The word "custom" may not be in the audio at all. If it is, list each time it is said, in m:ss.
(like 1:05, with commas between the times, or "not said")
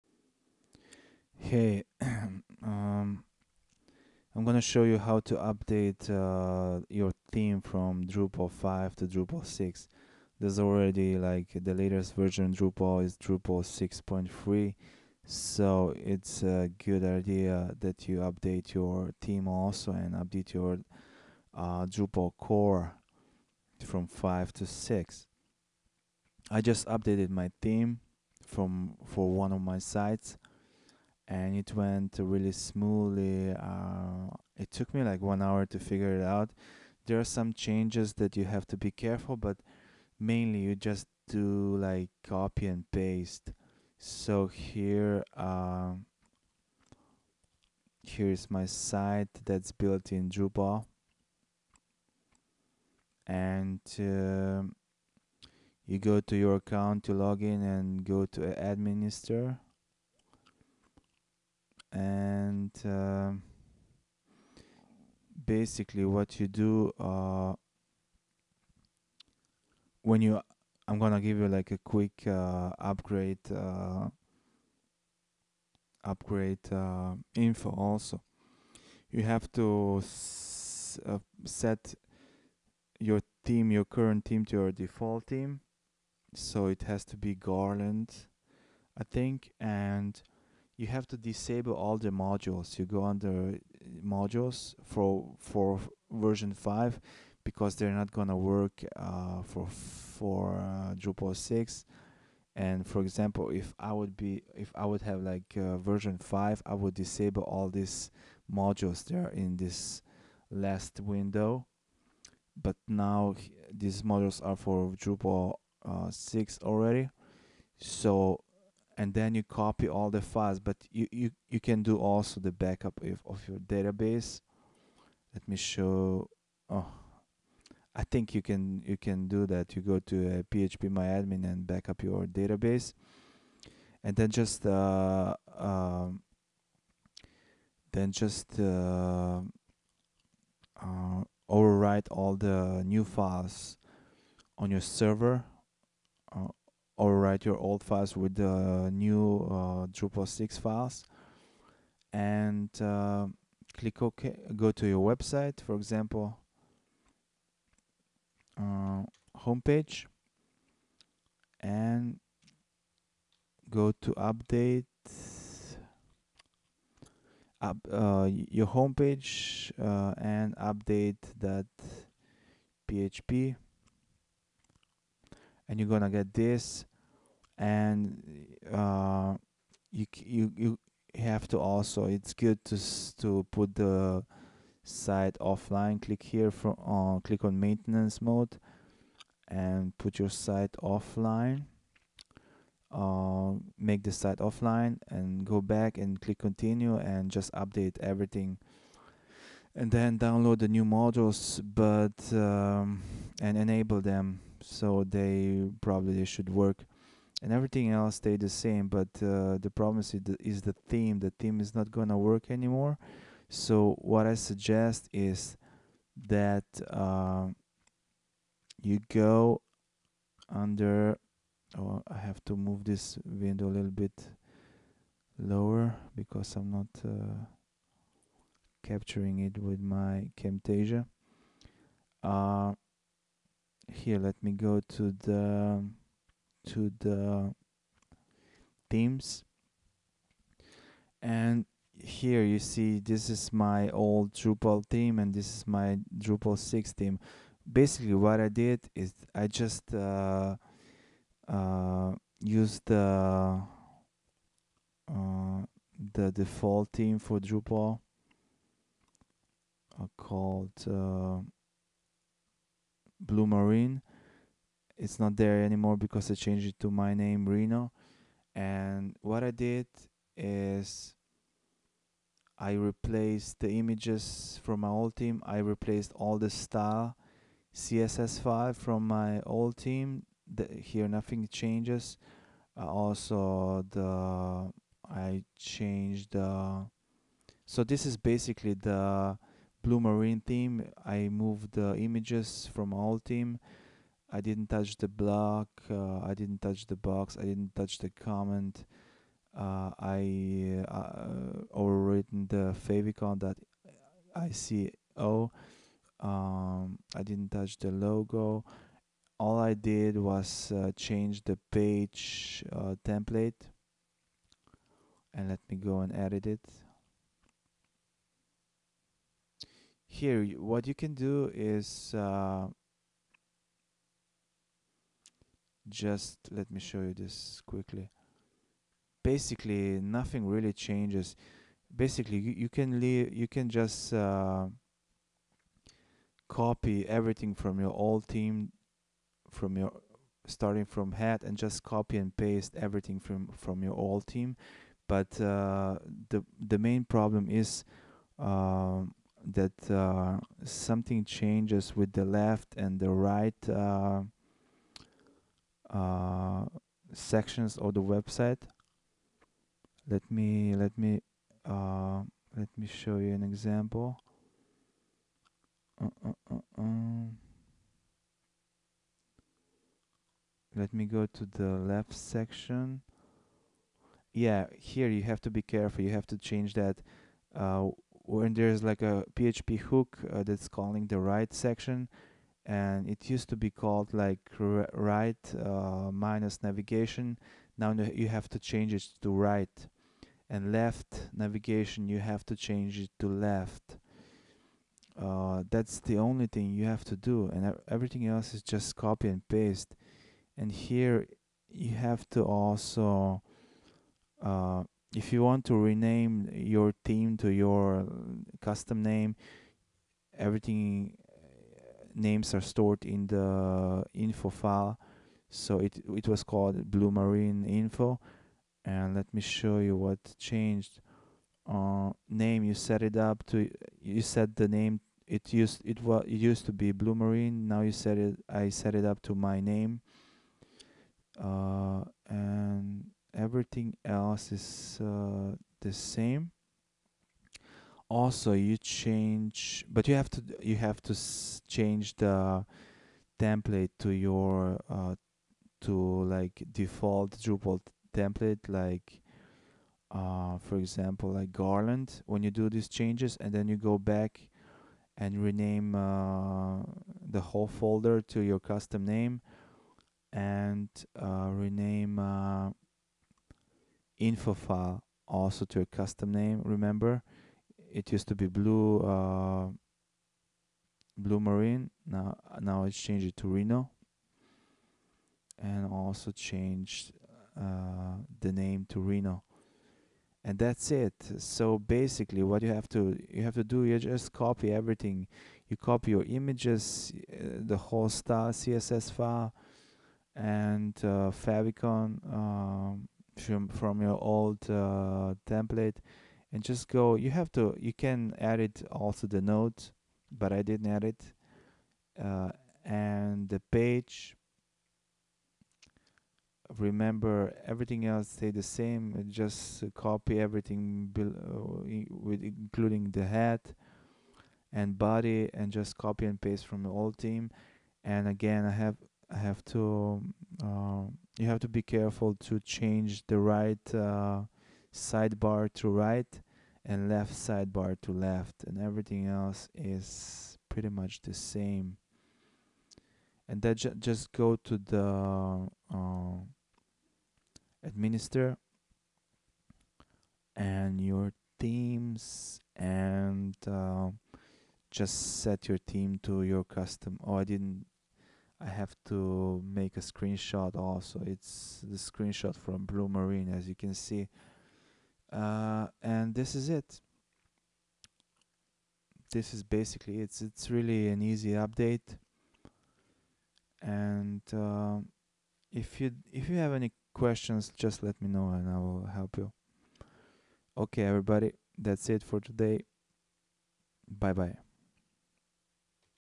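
6:48, 7:38, 7:45, 9:06.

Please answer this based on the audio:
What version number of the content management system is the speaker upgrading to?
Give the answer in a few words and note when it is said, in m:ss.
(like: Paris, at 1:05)
6.3, at 0:13.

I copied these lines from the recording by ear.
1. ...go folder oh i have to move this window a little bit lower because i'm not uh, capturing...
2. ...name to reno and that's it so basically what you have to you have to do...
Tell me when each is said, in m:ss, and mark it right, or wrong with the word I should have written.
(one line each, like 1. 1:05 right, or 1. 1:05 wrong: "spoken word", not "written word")
1. 3:39 wrong: "under", not "folder"
2. 7:58 right.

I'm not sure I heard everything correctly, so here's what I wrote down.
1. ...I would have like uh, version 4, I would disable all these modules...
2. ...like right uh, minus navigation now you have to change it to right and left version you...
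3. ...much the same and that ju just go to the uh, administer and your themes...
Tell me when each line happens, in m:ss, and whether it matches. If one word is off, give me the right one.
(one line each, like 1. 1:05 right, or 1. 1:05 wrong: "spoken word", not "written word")
1. 1:44 wrong: "5", not "4"
2. 6:24 wrong: "navigation", not "version"
3. 8:50 right.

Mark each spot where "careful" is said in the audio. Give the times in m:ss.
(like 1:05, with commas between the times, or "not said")
0:38, 6:15, 8:41.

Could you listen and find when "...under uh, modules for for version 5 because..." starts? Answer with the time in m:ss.
1:33.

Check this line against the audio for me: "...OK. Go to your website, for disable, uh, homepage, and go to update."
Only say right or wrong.
wrong.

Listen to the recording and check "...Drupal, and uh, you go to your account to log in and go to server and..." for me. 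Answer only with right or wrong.
wrong.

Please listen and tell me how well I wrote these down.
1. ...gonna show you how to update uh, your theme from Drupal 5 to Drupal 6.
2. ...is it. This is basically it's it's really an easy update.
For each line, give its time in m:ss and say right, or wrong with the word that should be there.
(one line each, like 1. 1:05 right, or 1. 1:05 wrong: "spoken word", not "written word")
1. 0:04 right
2. 9:16 right.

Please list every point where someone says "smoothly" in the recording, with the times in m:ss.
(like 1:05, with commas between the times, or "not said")
0:32.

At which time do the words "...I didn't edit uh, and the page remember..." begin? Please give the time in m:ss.
8:20.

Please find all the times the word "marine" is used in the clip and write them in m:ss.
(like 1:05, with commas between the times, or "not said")
4:23, 4:49, 6:57, 7:07, 7:51, 9:13.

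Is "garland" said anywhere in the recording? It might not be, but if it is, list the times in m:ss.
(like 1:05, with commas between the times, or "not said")
1:27, 7:31.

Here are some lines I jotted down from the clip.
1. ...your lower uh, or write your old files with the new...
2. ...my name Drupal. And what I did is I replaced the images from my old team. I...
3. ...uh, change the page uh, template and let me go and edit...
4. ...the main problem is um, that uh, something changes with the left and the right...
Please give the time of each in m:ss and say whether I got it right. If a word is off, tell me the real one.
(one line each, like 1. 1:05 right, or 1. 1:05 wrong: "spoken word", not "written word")
1. 2:24 wrong: "server", not "lower"
2. 4:26 wrong: "Reno", not "Drupal"
3. 5:10 right
4. 5:46 right.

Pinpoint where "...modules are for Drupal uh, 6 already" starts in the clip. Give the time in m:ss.
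1:54.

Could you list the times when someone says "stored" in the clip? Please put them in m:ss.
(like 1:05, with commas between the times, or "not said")
6:52.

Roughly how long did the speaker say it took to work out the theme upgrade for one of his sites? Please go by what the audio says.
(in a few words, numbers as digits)
one hour.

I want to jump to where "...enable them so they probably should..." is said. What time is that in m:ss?
3:23.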